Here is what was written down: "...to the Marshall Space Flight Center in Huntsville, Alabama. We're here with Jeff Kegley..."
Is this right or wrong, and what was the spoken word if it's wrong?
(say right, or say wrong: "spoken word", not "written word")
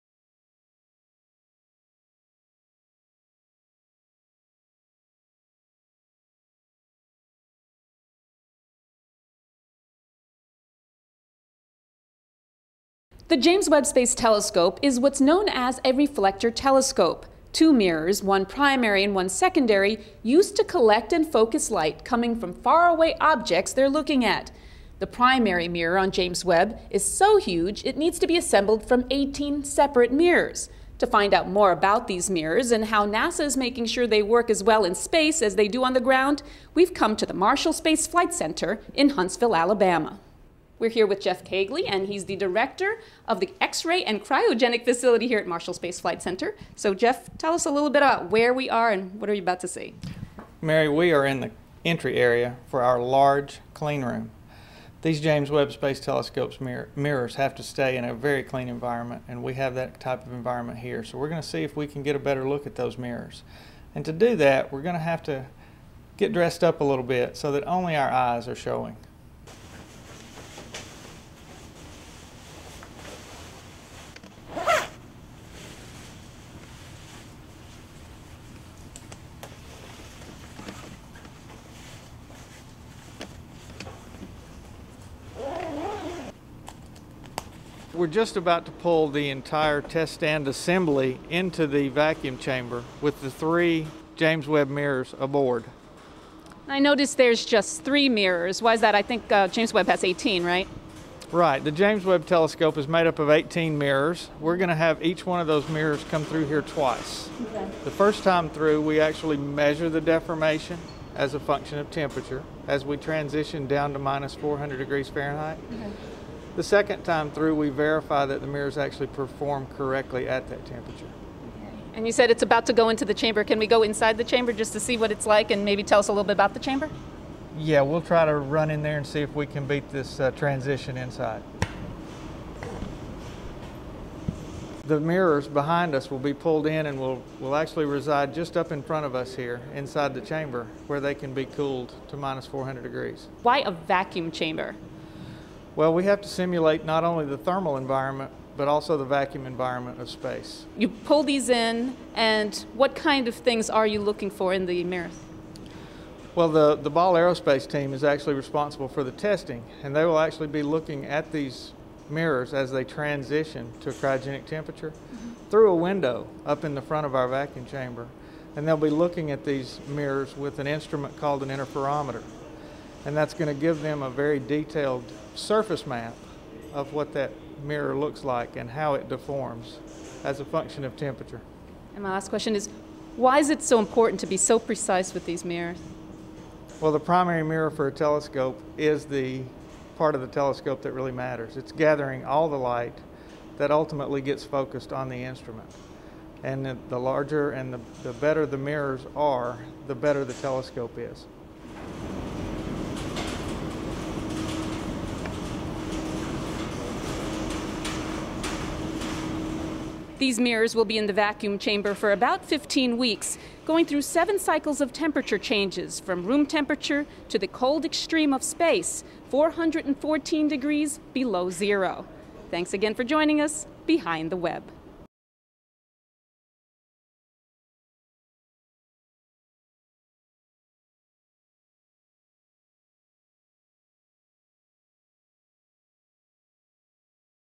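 right.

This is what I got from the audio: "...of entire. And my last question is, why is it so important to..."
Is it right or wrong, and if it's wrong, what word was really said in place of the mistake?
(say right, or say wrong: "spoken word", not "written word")
wrong: "temperature", not "entire".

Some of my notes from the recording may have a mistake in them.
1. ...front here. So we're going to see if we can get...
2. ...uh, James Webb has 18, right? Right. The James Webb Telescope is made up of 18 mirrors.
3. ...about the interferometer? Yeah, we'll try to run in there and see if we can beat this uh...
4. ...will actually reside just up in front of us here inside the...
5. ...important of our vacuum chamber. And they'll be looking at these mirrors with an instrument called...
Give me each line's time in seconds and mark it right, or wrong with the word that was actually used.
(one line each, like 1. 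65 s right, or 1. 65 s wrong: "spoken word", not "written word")
1. 60 s wrong: "environment", not "front"
2. 99 s right
3. 126 s wrong: "chamber", not "interferometer"
4. 137 s right
5. 166 s wrong: "front", not "important".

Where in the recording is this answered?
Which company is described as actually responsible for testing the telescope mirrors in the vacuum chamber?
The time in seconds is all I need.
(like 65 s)
156 s.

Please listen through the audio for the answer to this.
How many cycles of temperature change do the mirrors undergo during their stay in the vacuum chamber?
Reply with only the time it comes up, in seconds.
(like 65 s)
214 s.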